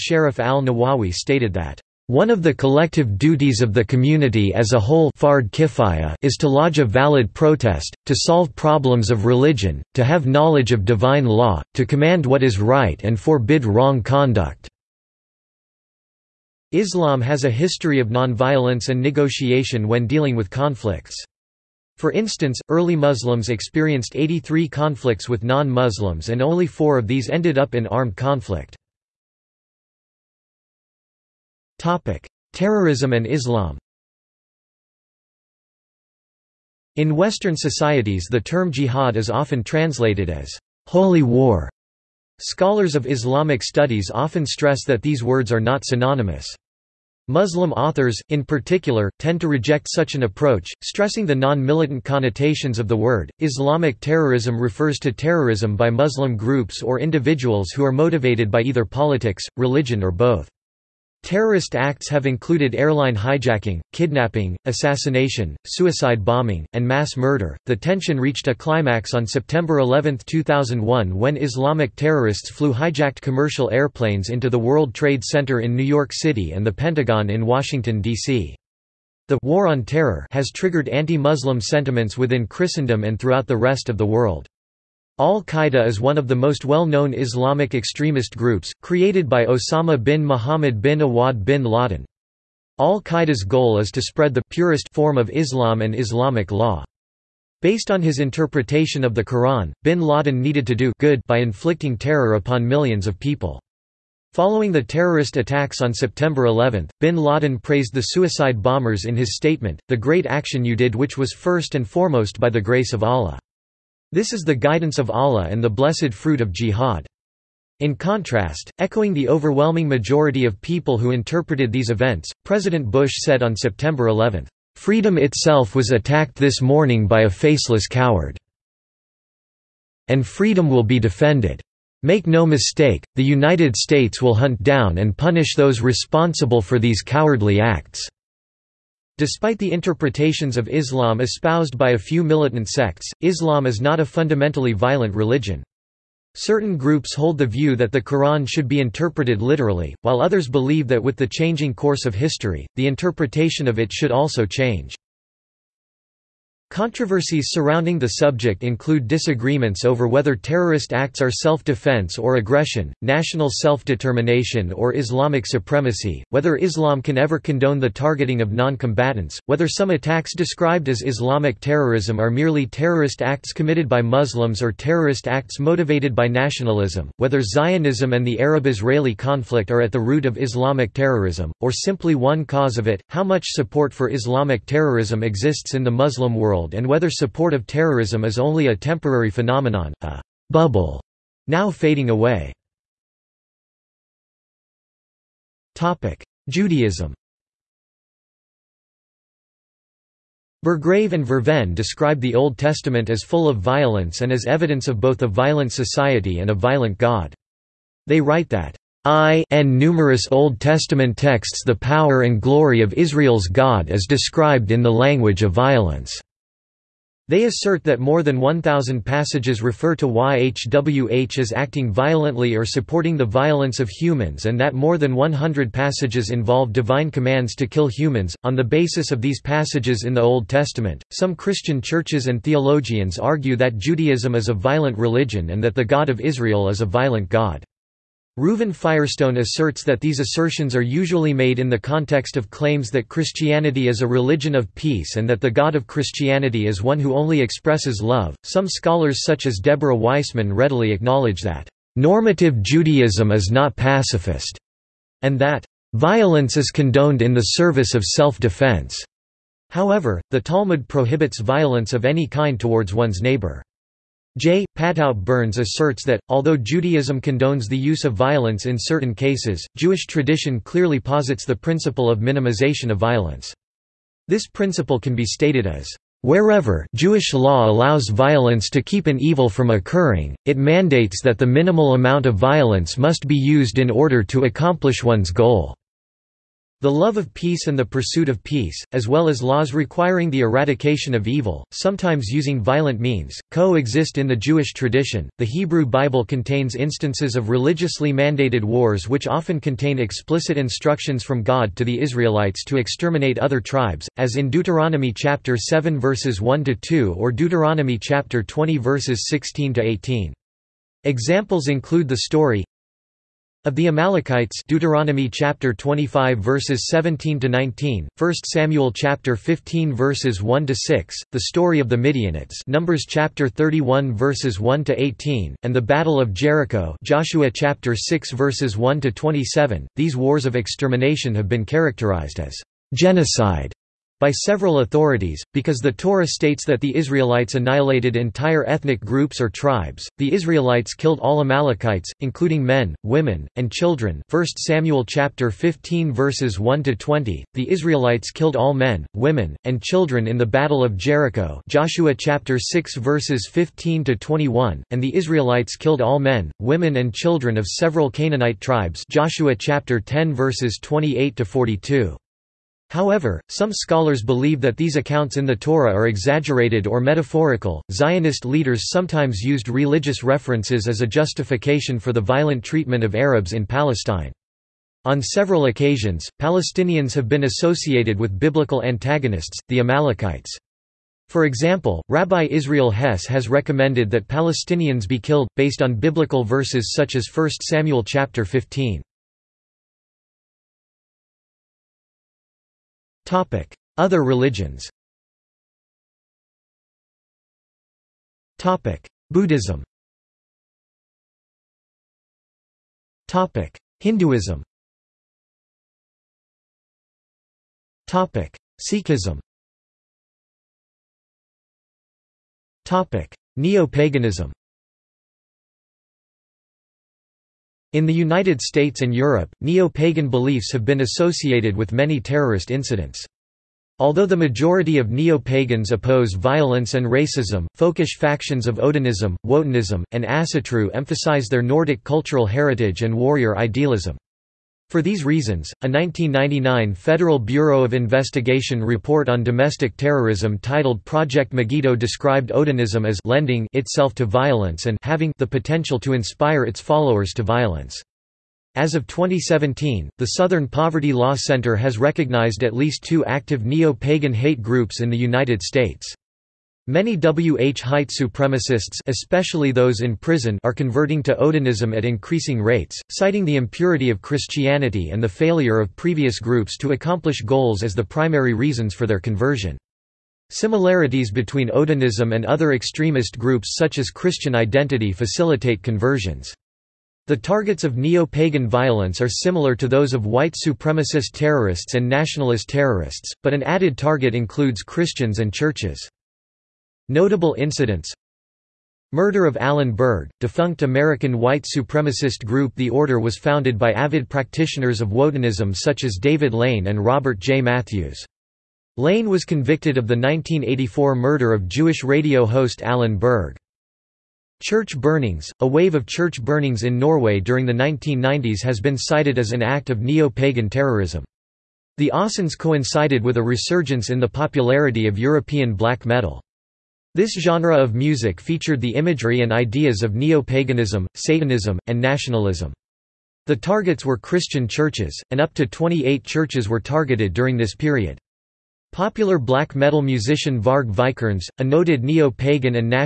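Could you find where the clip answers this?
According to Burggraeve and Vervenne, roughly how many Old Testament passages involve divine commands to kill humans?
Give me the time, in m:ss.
3:44.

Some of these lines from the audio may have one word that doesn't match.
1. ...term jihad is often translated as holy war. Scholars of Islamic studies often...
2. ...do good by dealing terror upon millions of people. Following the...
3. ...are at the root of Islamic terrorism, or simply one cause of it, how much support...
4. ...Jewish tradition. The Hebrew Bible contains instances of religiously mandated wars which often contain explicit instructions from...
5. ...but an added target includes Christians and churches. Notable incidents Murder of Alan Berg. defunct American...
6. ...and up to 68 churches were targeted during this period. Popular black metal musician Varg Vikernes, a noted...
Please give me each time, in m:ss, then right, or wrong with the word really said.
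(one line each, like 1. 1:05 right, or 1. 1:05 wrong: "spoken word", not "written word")
1. 0:38 right
2. 1:40 wrong: "inflicting", not "dealing"
3. 2:59 right
4. 4:54 right
5. 8:03 right
6. 8:45 wrong: "28", not "68".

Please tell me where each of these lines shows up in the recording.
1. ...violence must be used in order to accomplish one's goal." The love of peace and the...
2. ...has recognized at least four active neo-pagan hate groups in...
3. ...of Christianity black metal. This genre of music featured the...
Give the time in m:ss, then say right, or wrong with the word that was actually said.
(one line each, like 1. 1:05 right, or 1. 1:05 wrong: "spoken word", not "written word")
1. 4:42 right
2. 7:31 wrong: "two", not "four"
3. 8:35 wrong: "European", not "Christianity".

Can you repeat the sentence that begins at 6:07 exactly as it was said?
Zionist leaders sometimes used religious references as a justification for the violent treatment of Arabs in Palestine.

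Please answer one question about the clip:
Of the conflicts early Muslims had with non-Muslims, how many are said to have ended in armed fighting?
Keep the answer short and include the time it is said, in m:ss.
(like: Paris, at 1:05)
4, at 0:26.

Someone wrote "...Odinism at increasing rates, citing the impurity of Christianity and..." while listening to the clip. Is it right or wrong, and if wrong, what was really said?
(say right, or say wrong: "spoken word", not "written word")
right.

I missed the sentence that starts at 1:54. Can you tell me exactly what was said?
This is the guidance of Allah and the blessed fruit of jihad.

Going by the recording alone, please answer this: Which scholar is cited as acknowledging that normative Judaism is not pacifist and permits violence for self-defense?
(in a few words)
Deborah Weissman.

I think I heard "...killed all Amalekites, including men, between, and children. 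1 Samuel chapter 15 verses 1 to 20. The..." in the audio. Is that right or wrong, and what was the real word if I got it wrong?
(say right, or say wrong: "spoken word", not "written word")
wrong: "women", not "between".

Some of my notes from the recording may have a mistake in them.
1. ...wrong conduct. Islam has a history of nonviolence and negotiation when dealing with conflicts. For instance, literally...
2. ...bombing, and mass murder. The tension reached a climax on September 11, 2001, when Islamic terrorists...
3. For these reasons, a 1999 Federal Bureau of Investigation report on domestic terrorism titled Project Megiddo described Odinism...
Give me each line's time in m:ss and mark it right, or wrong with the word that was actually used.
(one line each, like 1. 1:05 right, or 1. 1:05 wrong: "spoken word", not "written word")
1. 0:13 wrong: "early", not "literally"
2. 1:06 right
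3. 7:14 right.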